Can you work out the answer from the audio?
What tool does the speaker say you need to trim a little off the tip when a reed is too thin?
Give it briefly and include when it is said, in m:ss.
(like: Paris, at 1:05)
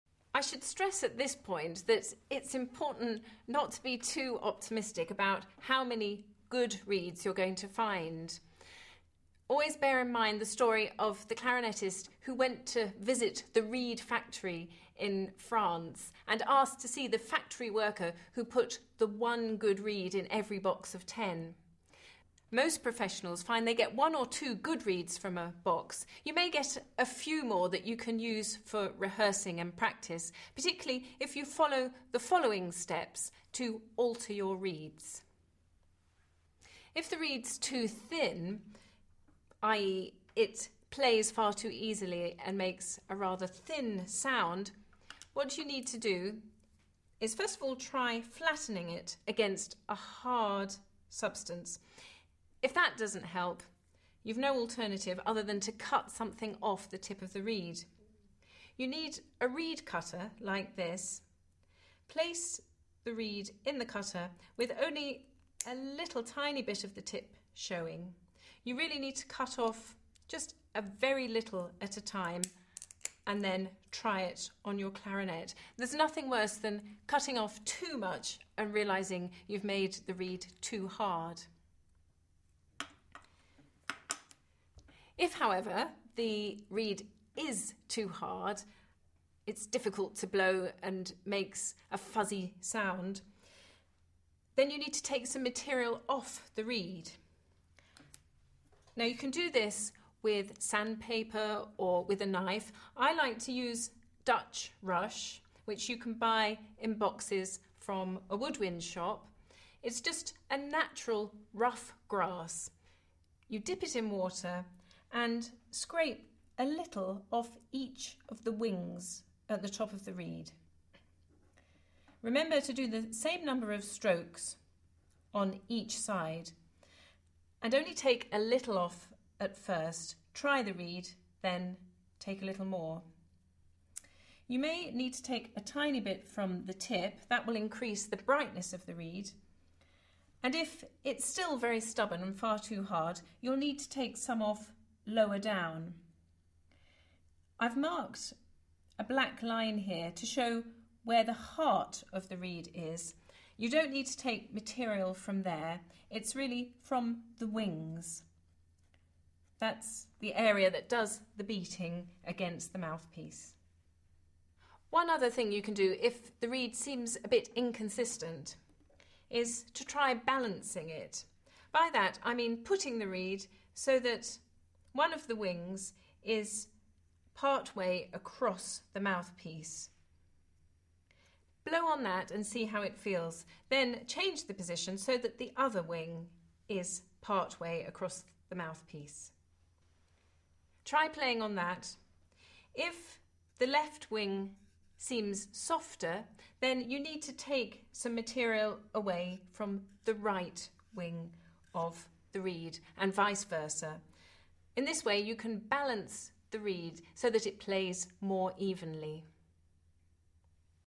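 Reed cutter, at 0:59.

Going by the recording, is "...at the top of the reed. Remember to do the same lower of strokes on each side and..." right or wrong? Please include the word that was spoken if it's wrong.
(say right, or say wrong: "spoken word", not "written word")
wrong: "number", not "lower".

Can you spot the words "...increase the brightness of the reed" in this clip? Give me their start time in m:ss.
2:17.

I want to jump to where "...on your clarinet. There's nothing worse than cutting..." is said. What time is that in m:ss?
1:14.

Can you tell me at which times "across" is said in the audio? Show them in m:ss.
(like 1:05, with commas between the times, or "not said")
2:58, 3:07.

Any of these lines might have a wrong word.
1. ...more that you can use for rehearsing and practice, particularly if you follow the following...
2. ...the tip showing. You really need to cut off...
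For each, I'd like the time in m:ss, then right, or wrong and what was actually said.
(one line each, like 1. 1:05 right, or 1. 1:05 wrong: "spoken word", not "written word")
1. 0:27 right
2. 1:06 right.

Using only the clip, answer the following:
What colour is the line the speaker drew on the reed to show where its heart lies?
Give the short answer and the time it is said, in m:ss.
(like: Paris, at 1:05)
Black, at 2:29.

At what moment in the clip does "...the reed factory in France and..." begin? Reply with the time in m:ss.
0:13.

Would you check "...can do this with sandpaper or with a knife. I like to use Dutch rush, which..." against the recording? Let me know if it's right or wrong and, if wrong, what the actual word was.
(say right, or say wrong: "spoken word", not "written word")
right.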